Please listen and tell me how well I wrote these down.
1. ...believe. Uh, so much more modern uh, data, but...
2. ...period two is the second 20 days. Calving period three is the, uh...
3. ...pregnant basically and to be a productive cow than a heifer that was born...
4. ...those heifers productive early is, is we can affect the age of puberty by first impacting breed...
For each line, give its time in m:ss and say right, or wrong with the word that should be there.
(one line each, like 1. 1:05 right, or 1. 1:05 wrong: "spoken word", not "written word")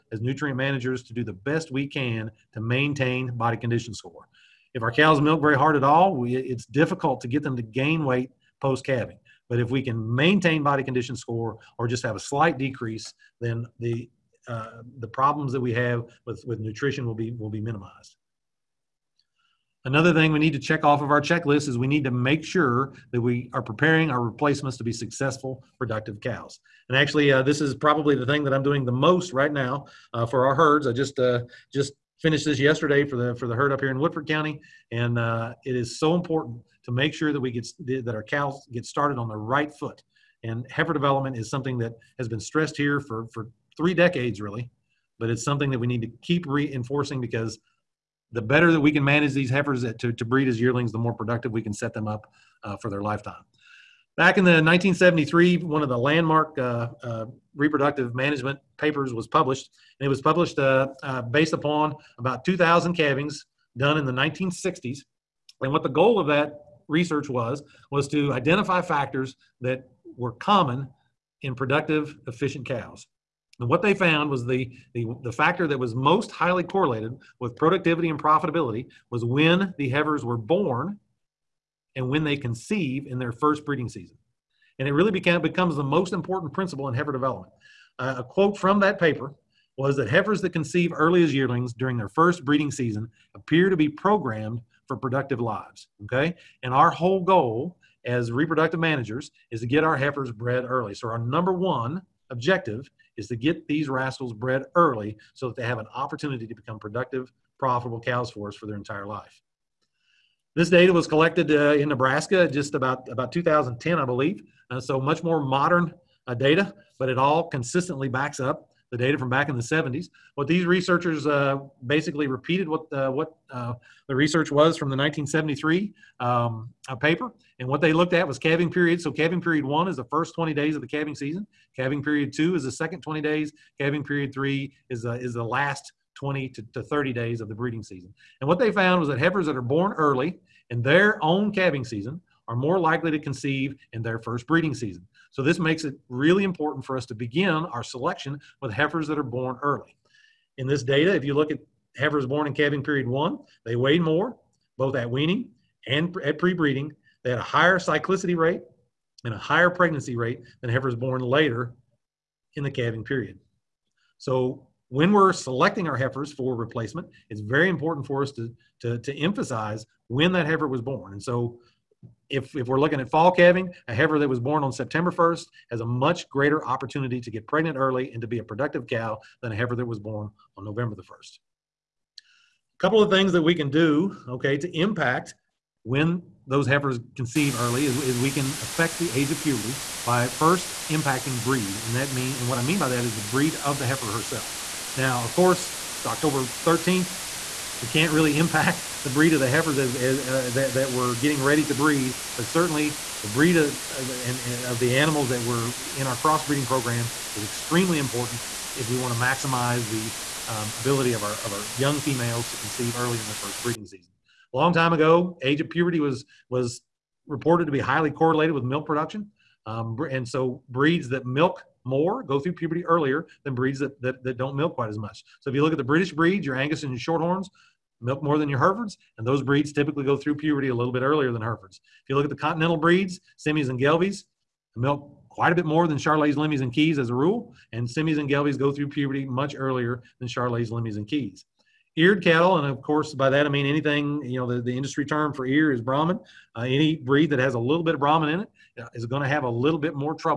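1. 1:54 right
2. 2:12 right
3. 2:57 wrong: "early", not "basically"
4. 3:06 wrong: "conceive", not "productive".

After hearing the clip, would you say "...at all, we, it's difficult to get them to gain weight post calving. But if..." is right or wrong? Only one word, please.
right.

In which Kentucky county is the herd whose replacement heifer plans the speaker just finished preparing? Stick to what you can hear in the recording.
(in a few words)
Woodford County.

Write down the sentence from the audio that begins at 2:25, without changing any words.
So this makes it really important for us to begin our selection with heifers that are born early.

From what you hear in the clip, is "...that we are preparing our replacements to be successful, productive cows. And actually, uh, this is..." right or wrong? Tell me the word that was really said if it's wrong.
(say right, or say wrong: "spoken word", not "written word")
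right.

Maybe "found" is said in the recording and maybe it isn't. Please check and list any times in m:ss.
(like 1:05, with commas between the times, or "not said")
1:13, 2:18.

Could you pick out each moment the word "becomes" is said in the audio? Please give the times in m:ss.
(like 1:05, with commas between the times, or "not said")
1:25, 1:46.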